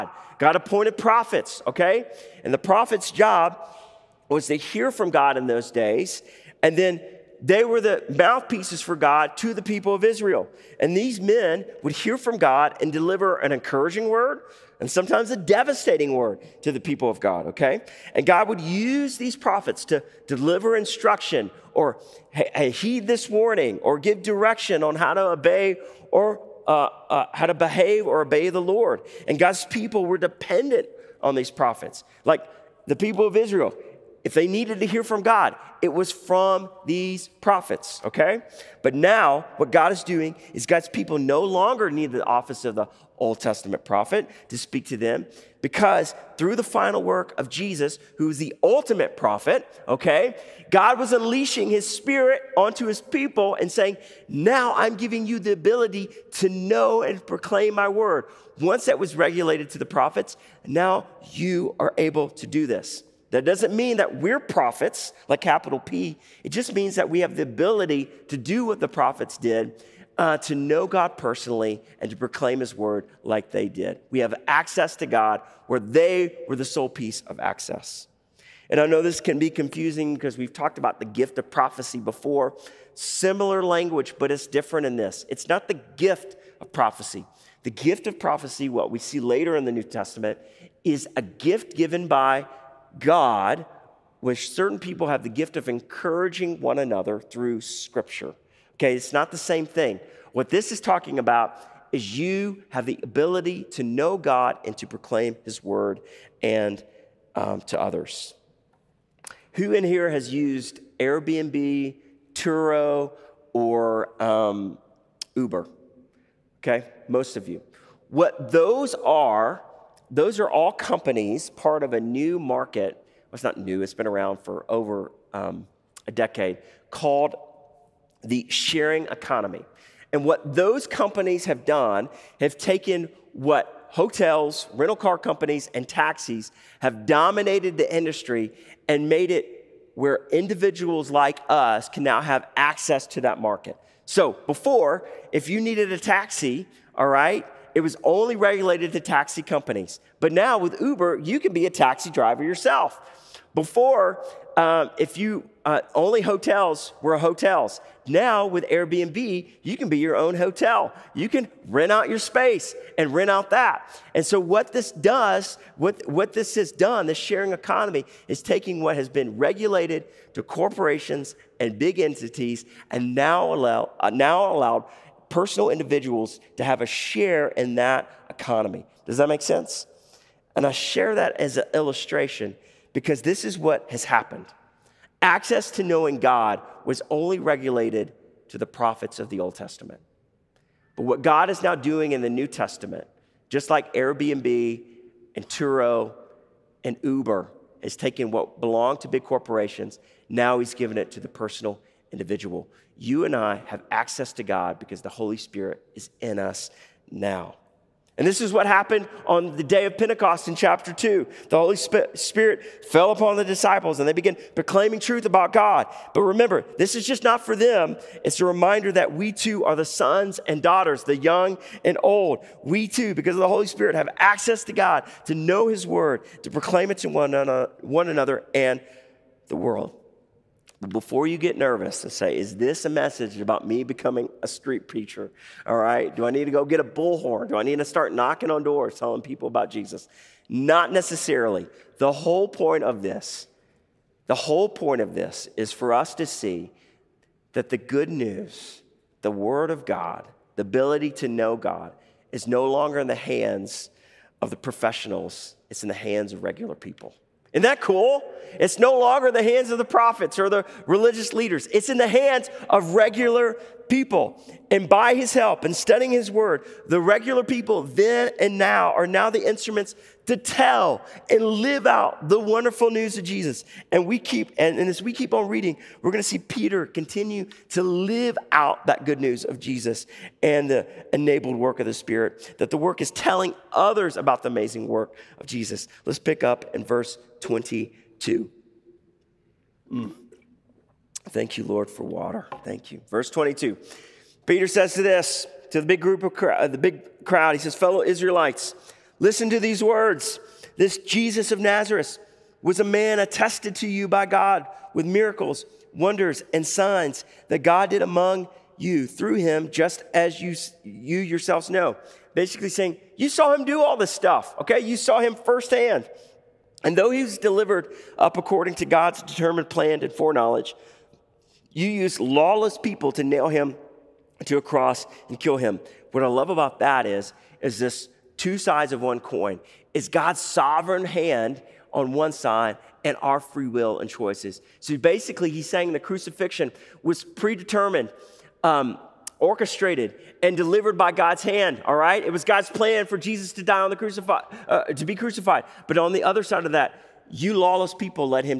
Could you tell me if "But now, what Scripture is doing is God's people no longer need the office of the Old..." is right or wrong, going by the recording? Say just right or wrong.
wrong.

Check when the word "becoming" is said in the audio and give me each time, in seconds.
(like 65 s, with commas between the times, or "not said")
233 s.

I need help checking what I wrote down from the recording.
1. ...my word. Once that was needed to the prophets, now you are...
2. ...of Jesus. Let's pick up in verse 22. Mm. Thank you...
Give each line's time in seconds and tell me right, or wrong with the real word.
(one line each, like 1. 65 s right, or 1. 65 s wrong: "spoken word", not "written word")
1. 57 s wrong: "regulated", not "needed"
2. 285 s right.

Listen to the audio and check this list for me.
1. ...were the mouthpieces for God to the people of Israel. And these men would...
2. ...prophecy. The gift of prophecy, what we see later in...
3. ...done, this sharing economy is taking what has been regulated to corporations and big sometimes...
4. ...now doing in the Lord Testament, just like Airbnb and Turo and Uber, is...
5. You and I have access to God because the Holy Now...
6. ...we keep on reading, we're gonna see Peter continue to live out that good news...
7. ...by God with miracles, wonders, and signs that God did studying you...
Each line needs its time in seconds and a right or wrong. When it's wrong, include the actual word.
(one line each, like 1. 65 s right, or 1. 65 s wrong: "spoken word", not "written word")
1. 7 s right
2. 86 s right
3. 166 s wrong: "entities", not "sometimes"
4. 191 s wrong: "New", not "Lord"
5. 202 s wrong: "Spirit", not "Now"
6. 275 s right
7. 304 s wrong: "among", not "studying".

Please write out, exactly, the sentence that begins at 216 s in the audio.
But remember, this is just not for them.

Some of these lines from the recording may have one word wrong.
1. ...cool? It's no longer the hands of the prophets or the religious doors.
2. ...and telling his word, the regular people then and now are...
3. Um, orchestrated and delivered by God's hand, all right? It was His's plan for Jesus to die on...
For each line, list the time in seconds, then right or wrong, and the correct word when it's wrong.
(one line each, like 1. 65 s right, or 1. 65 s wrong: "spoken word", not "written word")
1. 257 s wrong: "leaders", not "doors"
2. 265 s wrong: "studying", not "telling"
3. 338 s wrong: "God", not "His".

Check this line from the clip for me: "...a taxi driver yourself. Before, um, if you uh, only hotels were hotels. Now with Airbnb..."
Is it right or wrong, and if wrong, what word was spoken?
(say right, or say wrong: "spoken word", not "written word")
right.